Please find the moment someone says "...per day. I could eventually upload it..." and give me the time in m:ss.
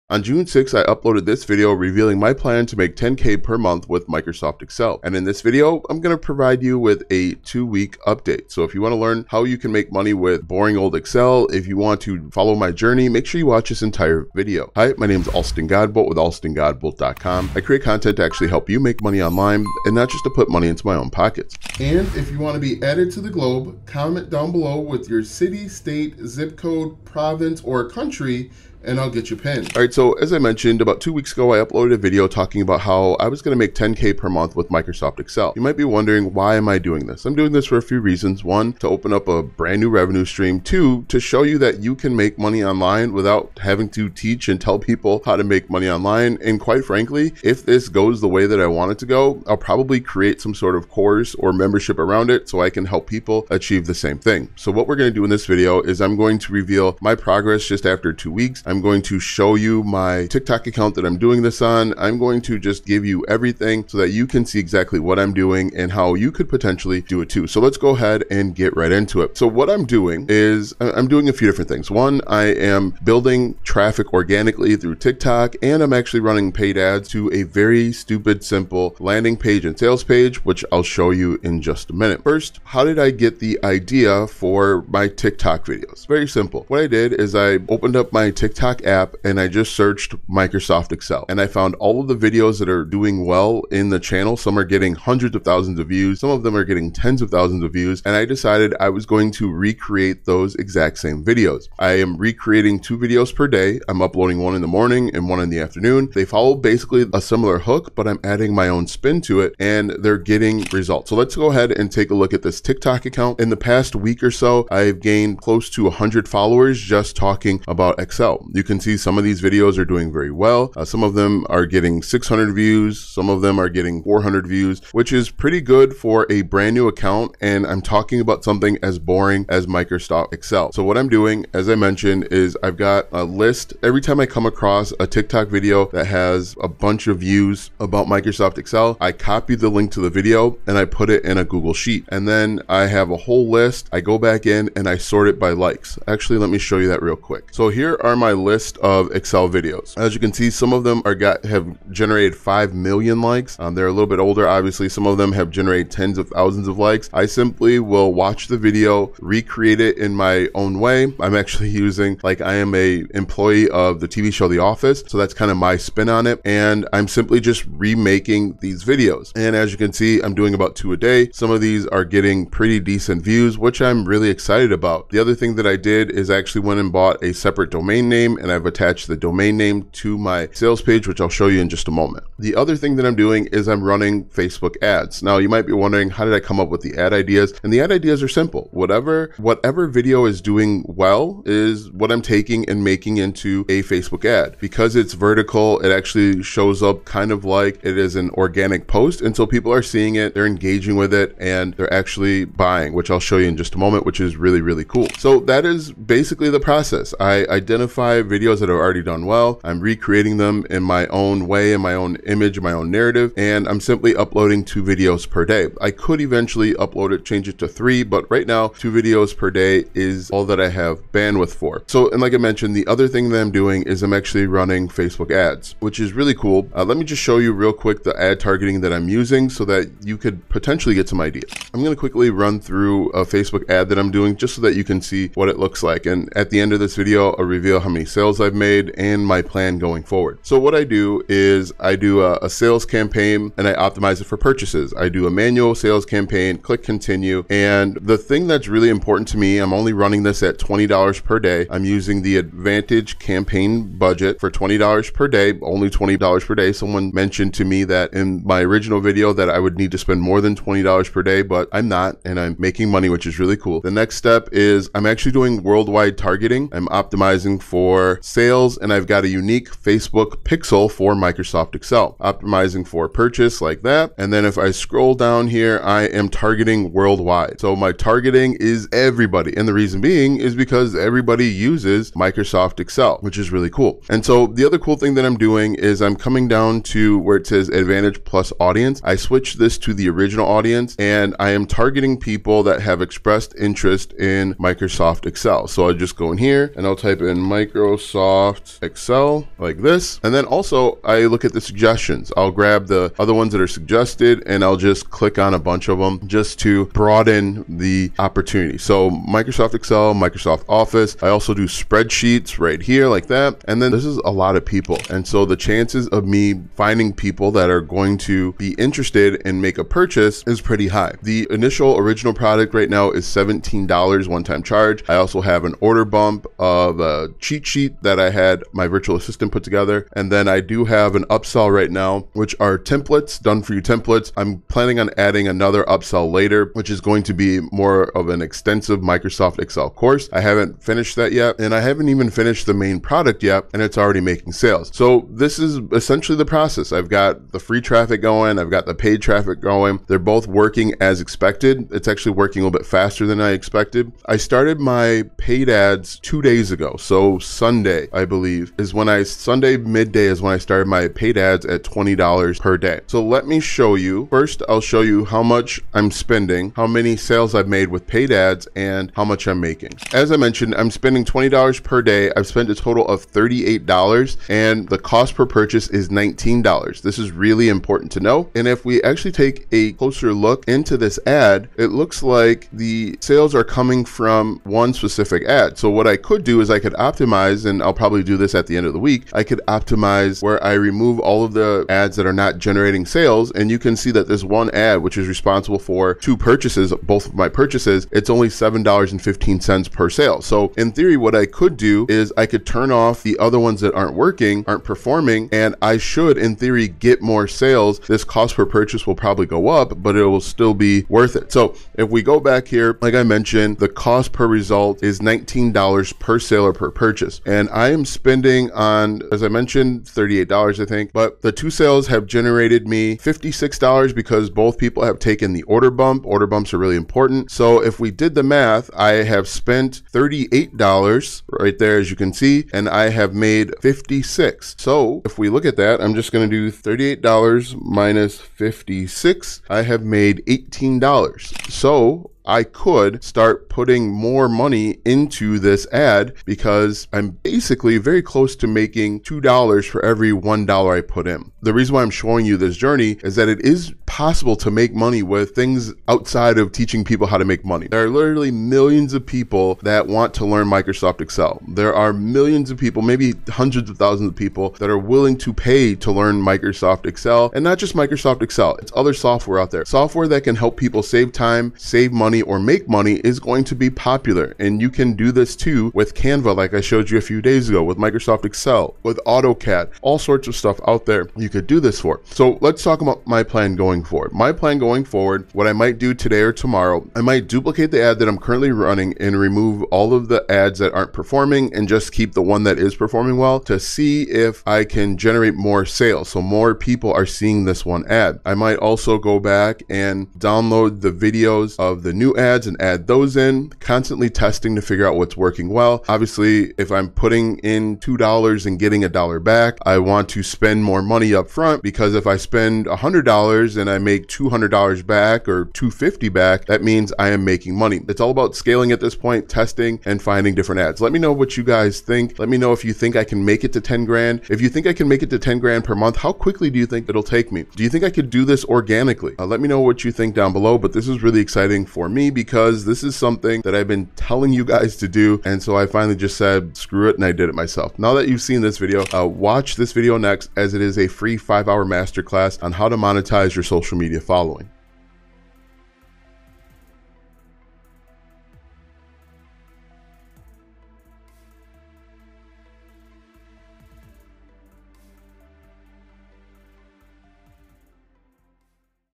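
3:35.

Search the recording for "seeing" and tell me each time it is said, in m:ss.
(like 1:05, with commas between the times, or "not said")
3:19, 8:17.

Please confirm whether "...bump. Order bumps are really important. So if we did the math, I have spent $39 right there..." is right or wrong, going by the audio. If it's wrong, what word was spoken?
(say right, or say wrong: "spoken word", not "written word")
wrong: "38", not "39".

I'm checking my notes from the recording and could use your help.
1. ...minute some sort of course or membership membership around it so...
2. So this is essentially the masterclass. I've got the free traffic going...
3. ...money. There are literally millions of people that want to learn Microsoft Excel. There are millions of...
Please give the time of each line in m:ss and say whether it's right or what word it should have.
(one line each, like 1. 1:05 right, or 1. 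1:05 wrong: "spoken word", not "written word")
1. 0:50 wrong: "create", not "minute"
2. 5:44 wrong: "process", not "masterclass"
3. 7:37 right.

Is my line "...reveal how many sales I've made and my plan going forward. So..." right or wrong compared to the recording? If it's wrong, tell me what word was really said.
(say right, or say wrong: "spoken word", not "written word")
right.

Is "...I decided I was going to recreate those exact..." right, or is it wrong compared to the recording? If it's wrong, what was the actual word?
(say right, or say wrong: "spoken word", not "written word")
right.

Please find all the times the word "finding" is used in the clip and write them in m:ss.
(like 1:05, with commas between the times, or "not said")
5:16, 8:40.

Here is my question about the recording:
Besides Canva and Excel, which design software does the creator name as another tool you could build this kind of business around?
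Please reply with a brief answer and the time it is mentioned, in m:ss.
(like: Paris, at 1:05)
AutoCAD, at 7:59.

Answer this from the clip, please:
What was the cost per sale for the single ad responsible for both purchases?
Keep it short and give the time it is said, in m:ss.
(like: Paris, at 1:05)
$7.15, at 6:38.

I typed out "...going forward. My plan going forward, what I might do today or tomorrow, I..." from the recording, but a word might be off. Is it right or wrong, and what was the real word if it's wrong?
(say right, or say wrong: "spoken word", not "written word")
right.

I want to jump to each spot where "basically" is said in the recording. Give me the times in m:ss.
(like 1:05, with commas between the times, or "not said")
1:46, 3:25, 7:27.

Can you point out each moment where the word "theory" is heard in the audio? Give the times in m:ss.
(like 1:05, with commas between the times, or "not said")
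6:40, 6:46.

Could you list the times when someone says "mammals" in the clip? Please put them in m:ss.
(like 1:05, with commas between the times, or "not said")
not said.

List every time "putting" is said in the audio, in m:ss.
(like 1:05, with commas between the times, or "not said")
7:23, 8:27.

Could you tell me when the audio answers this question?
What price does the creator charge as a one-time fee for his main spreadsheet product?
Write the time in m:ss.
5:23.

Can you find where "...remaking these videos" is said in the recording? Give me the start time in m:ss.
2:47.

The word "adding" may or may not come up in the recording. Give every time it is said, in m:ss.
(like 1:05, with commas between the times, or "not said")
1:48, 5:35.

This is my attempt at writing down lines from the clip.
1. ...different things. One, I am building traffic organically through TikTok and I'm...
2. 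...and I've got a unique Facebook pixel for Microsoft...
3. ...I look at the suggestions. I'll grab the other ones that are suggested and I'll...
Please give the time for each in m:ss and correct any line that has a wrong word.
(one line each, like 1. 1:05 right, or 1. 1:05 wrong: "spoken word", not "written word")
1. 1:11 right
2. 4:28 right
3. 5:01 right.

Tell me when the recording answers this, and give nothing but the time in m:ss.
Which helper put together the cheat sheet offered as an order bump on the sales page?
5:28.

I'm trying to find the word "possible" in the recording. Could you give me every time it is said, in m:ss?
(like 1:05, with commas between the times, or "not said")
7:34.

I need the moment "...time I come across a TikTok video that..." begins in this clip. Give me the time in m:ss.
2:14.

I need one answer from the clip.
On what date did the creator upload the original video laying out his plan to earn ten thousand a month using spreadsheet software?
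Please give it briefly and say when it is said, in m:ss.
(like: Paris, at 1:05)
June 6, at 0:00.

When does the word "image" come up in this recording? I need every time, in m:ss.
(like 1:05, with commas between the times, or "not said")
3:32.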